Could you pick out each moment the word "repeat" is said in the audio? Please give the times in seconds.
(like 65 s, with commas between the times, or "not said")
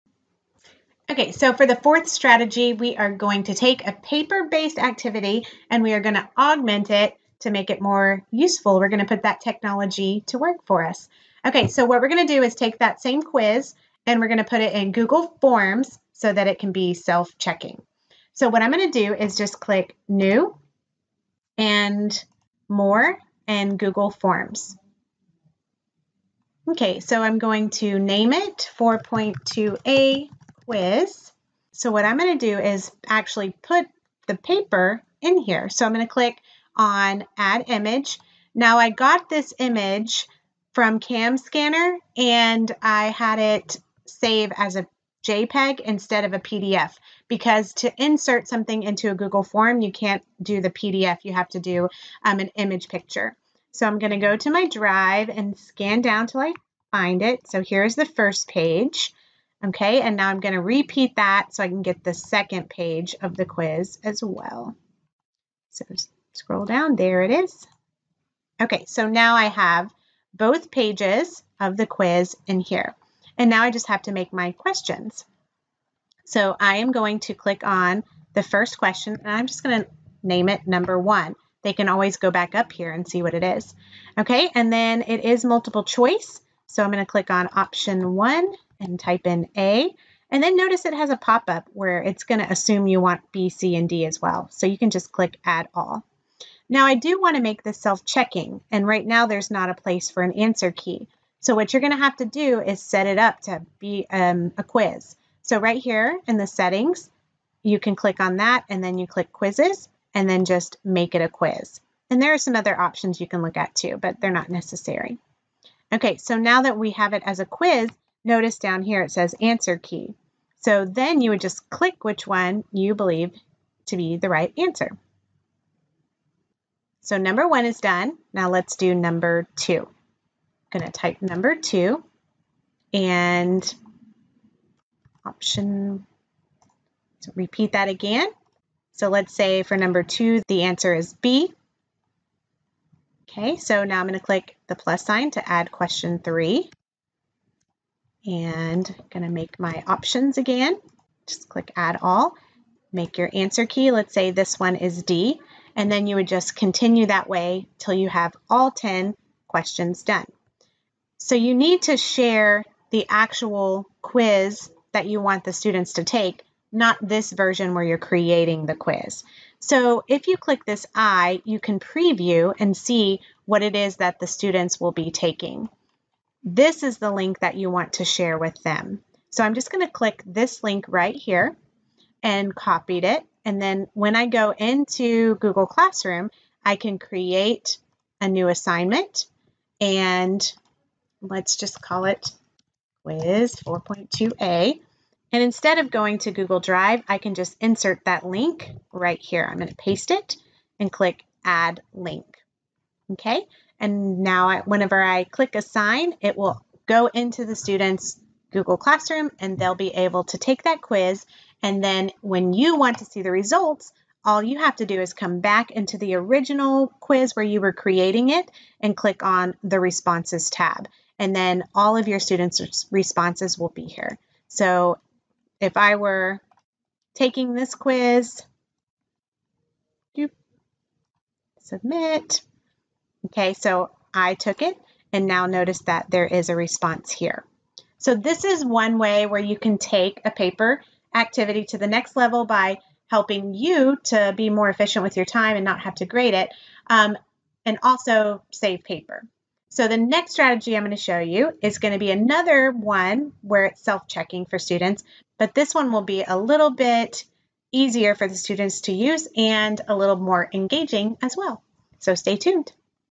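60 s, 137 s.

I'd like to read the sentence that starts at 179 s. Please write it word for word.
So I'm just going to click this link right here and copied it.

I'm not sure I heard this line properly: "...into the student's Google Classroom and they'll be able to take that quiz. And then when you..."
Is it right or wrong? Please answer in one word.
right.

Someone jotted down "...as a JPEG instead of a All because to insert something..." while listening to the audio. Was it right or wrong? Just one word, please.
wrong.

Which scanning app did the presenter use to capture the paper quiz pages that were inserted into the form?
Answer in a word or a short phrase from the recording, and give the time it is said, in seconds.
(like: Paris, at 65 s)
Cam Scanner, at 41 s.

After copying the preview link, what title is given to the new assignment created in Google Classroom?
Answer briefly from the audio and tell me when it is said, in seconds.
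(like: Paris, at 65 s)
quiz 4.2a, at 193 s.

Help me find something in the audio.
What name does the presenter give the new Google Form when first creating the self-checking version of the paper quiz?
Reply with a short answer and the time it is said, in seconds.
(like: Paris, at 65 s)
4.2a quiz, at 28 s.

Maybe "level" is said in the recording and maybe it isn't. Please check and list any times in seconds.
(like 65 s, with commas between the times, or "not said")
242 s.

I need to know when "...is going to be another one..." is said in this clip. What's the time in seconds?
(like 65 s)
251 s.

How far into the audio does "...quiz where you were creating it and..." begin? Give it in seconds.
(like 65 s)
216 s.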